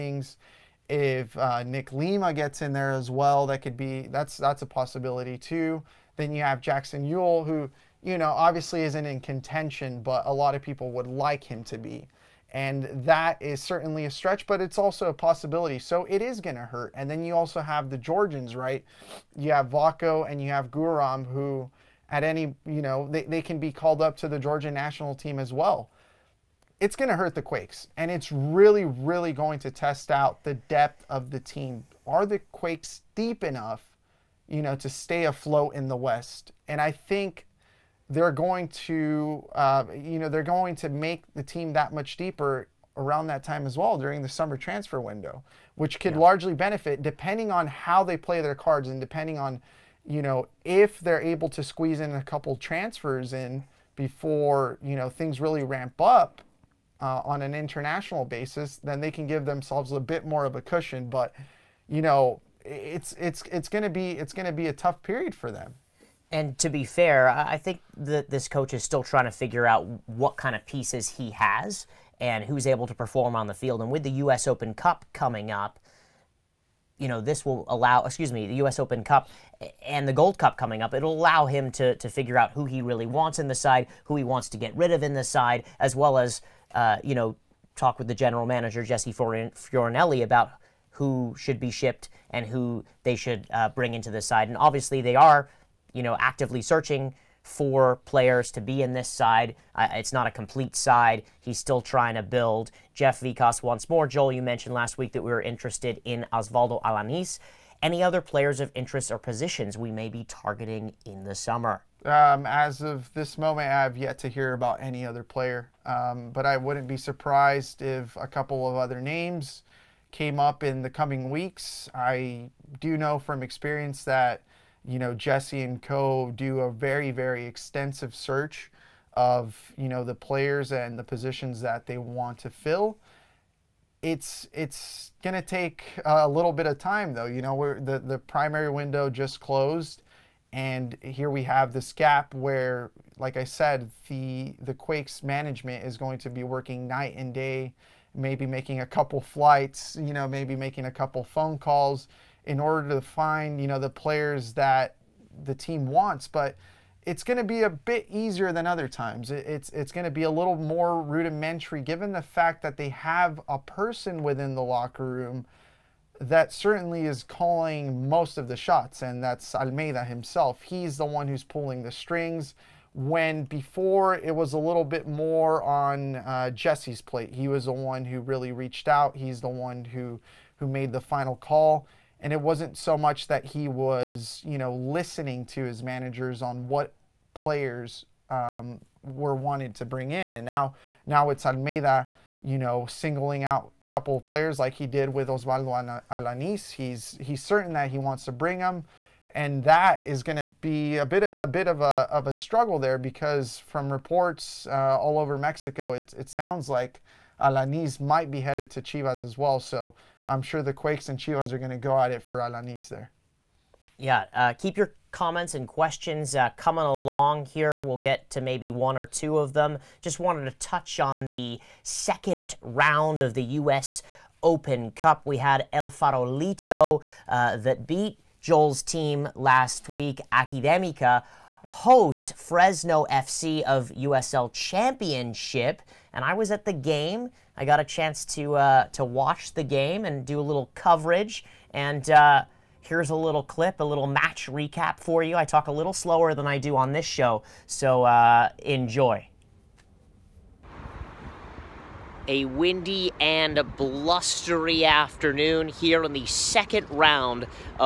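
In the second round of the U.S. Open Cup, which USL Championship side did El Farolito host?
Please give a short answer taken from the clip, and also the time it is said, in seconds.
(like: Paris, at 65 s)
Fresno FC, at 232 s.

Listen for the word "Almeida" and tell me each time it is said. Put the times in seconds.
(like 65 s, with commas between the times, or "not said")
169 s, 191 s.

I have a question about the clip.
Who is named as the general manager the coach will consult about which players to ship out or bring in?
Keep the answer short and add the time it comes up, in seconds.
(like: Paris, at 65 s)
Jesse Fioranelli, at 88 s.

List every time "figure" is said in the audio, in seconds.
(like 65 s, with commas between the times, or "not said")
69 s, 82 s.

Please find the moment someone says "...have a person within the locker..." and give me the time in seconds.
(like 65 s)
162 s.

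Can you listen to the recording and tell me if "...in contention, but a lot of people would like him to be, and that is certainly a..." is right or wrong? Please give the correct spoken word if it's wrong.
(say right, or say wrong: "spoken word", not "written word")
right.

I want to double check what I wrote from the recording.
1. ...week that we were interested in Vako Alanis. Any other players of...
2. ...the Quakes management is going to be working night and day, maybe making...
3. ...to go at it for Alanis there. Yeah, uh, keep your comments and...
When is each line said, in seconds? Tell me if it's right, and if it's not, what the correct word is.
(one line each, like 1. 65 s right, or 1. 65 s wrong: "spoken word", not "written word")
1. 104 s wrong: "Oswaldo", not "Vako"
2. 144 s right
3. 211 s right.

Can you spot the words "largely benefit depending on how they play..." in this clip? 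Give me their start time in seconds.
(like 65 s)
46 s.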